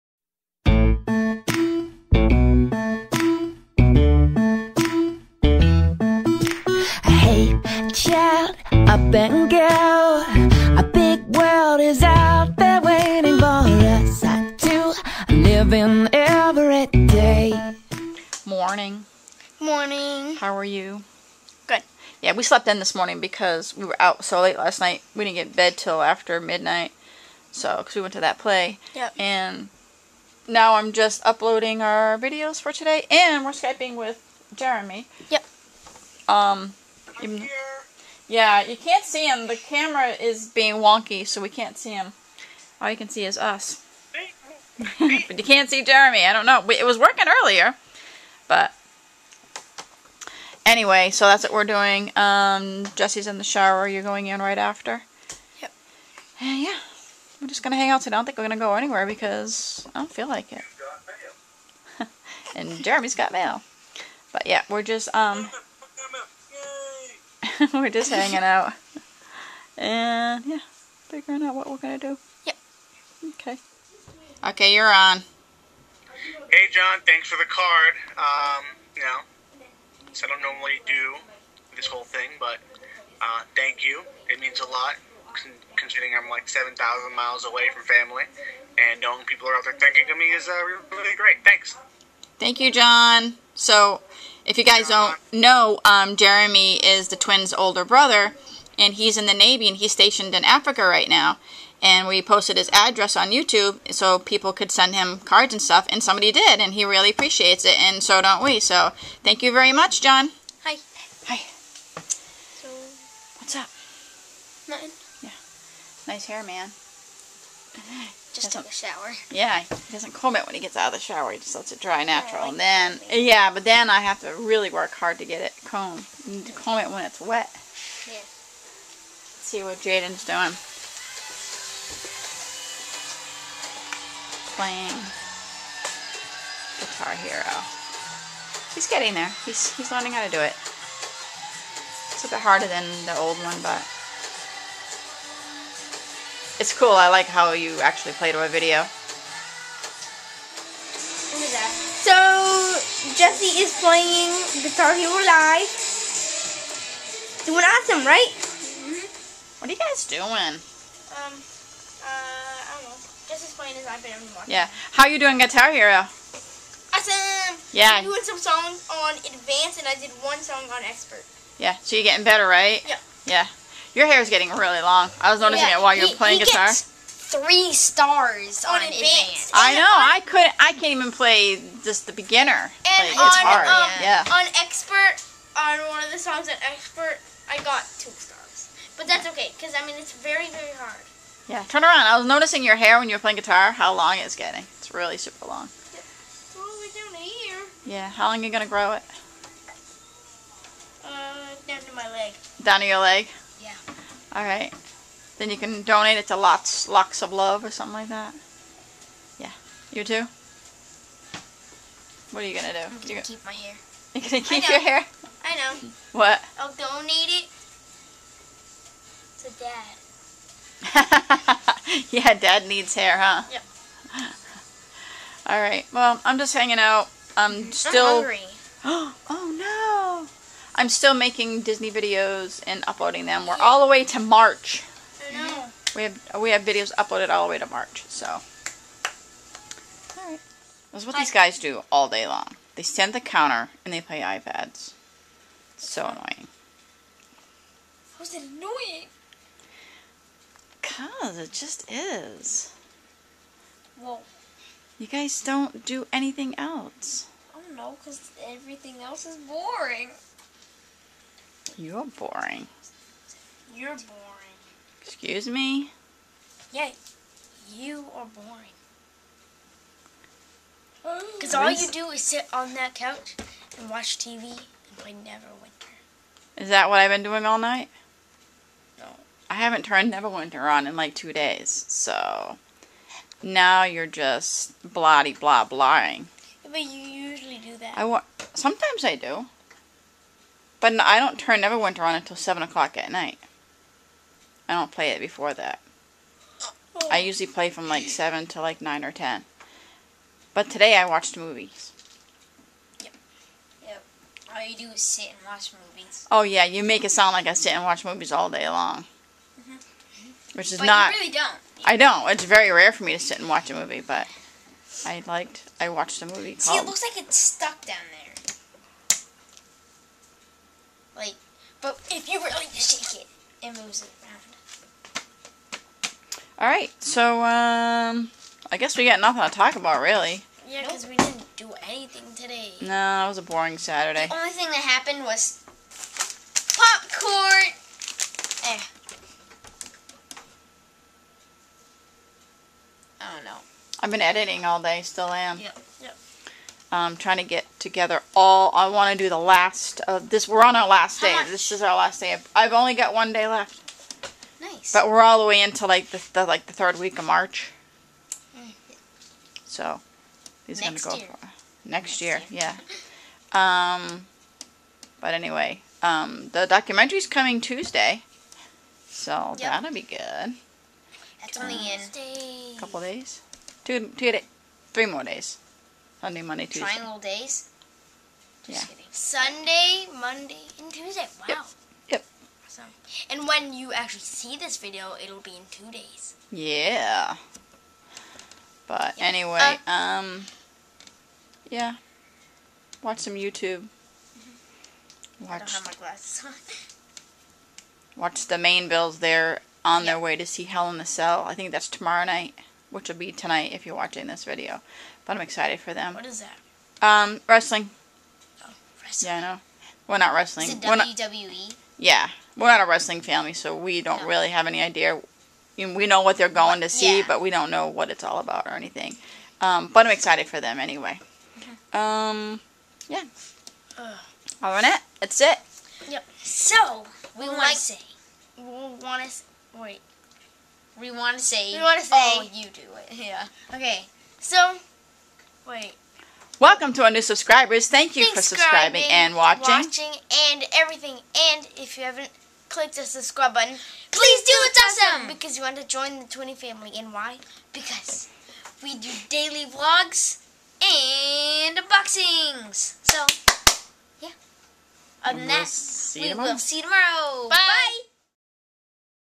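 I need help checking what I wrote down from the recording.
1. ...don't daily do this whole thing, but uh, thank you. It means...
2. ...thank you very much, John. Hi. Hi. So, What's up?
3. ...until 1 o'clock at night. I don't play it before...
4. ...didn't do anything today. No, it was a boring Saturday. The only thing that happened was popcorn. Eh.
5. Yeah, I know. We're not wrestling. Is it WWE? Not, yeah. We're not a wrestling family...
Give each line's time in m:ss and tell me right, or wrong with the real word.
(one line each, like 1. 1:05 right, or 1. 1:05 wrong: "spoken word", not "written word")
1. 1:20 wrong: "normally", not "daily"
2. 1:49 right
3. 4:52 wrong: "7", not "1"
4. 5:31 right
5. 6:49 right.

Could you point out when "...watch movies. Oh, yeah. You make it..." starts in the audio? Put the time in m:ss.
5:05.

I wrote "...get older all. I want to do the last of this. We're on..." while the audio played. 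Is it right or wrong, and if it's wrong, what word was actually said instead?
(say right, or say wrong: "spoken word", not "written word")
wrong: "together", not "older".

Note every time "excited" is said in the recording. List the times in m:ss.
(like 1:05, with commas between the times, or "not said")
6:45, 7:00.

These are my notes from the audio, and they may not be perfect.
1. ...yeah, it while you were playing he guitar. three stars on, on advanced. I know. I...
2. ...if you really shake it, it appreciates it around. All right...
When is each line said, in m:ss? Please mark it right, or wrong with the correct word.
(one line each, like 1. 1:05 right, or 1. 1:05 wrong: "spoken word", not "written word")
1. 2:55 right
2. 5:22 wrong: "moves", not "appreciates".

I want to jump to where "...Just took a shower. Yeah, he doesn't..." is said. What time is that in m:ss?
1:58.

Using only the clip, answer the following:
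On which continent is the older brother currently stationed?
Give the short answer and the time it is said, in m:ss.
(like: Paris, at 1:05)
Africa, at 1:40.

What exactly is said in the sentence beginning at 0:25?
We didn't get bed till after midnight.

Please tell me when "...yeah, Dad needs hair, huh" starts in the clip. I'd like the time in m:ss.
3:42.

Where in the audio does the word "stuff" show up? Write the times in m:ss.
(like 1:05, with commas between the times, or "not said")
1:45.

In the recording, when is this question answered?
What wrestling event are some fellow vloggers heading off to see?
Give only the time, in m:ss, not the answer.
6:40.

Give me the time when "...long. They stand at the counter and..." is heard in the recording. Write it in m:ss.
4:02.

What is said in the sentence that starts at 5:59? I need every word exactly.
So he's next gonna go year.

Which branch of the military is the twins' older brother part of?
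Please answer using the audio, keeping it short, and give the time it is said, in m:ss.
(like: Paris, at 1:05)
Navy, at 1:39.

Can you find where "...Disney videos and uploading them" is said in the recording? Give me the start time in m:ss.
3:51.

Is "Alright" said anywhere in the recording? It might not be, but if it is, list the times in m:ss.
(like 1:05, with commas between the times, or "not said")
3:24, 3:45, 4:00.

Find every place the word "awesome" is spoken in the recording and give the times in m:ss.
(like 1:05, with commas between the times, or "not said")
2:37, 2:46, 6:22, 7:25.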